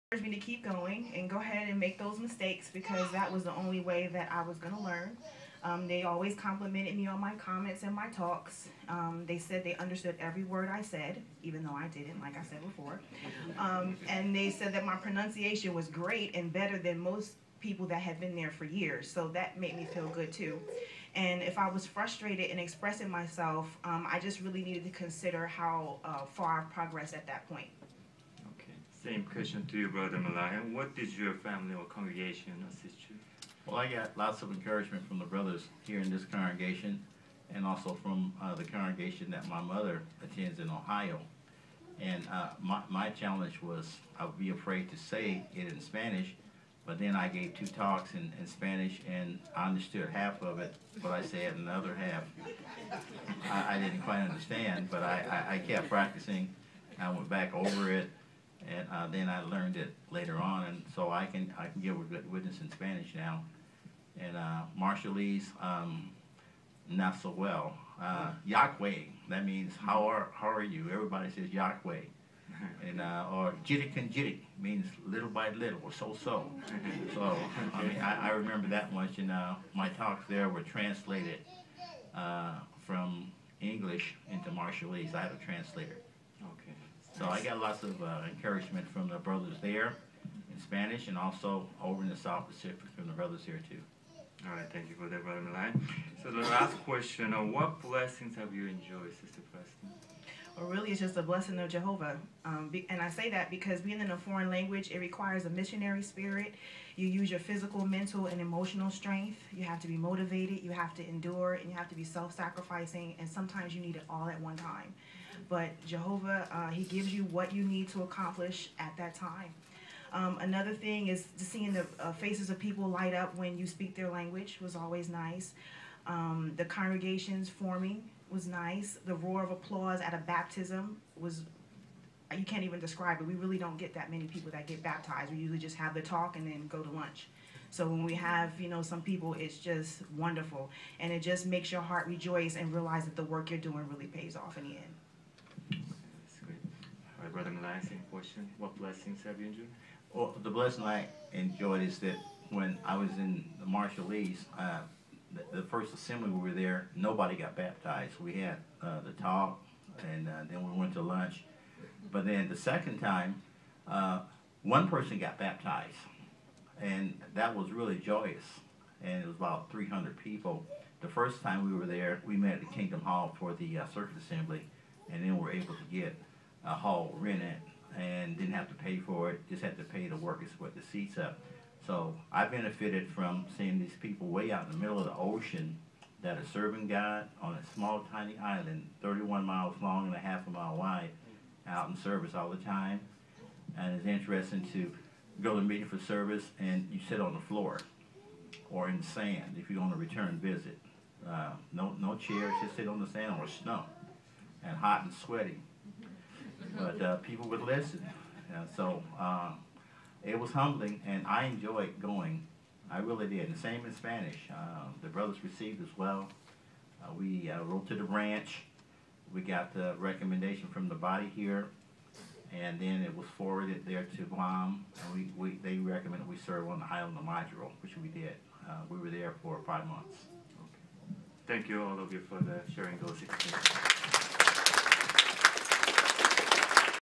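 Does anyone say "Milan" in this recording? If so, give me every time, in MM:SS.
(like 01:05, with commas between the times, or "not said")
01:35, 02:27.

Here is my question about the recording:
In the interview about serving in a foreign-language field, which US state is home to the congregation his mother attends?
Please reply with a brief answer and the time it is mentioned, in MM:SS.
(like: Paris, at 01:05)
Ohio, at 00:40.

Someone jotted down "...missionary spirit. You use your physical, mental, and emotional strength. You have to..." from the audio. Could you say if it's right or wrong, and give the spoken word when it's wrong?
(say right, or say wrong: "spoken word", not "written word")
right.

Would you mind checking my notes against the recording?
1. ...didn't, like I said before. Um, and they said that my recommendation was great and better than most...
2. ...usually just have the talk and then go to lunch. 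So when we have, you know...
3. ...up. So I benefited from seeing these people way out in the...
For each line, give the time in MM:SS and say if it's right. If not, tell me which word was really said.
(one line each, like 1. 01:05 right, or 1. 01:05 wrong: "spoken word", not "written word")
1. 00:11 wrong: "pronunciation", not "recommendation"
2. 02:15 right
3. 03:01 right.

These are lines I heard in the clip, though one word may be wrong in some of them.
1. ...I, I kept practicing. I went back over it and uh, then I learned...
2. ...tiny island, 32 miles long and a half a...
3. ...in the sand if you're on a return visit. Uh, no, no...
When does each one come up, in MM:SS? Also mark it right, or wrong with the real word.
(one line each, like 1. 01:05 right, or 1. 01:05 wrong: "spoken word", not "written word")
1. 00:55 right
2. 03:08 wrong: "31", not "32"
3. 03:18 right.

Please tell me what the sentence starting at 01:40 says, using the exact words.
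really, it's just a blessing of Jehovah.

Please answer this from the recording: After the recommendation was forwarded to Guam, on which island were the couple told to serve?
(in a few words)
Majuro.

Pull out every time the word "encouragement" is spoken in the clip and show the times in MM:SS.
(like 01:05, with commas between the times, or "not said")
00:34, 01:28.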